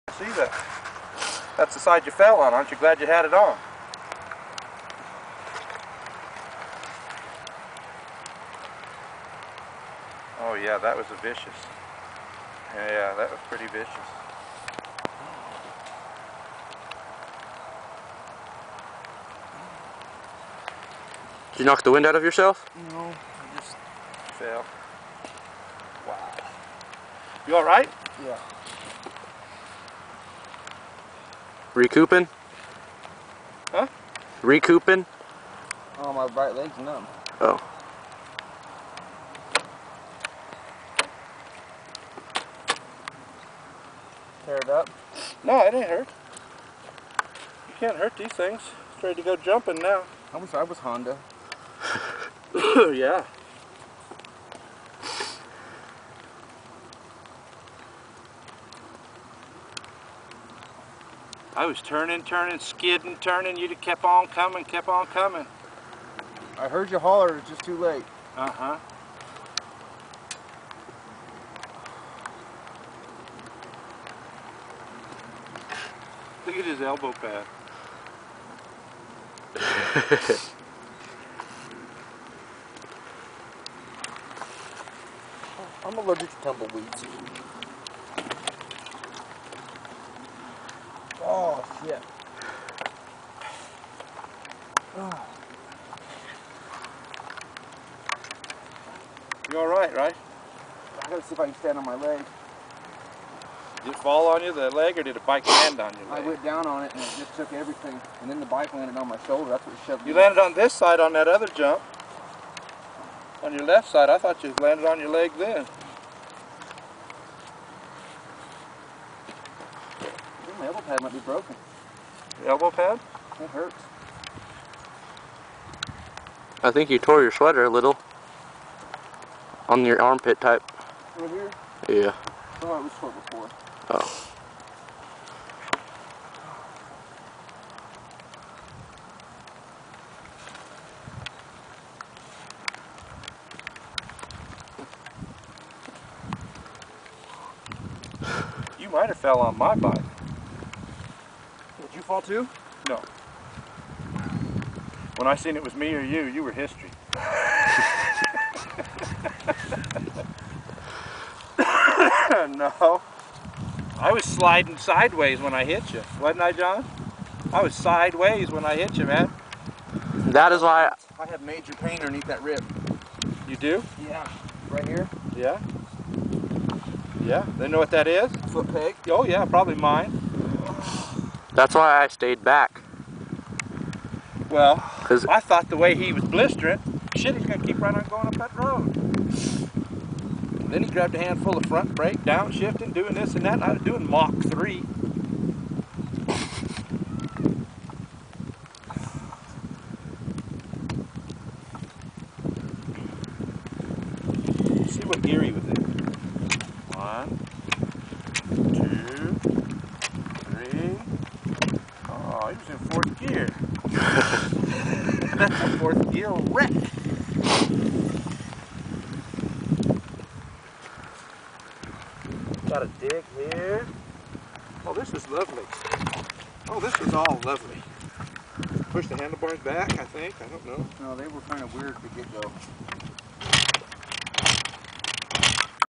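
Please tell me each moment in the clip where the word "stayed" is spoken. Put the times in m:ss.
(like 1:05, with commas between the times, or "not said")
3:02.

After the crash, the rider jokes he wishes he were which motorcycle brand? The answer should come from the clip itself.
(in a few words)
Honda.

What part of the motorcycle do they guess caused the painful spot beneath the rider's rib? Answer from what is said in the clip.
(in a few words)
foot peg.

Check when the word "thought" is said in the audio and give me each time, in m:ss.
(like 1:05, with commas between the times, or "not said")
1:54, 3:05.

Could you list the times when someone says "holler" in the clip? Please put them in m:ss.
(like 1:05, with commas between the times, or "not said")
1:06.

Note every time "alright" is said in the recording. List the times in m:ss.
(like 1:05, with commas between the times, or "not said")
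0:27, 1:39.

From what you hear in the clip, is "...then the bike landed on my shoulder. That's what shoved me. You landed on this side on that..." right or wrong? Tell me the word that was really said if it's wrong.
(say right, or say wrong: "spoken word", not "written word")
right.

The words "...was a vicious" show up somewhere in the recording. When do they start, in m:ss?
0:10.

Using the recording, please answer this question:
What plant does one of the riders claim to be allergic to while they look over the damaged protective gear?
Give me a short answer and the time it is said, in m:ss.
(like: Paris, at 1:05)
tumbleweeds, at 1:26.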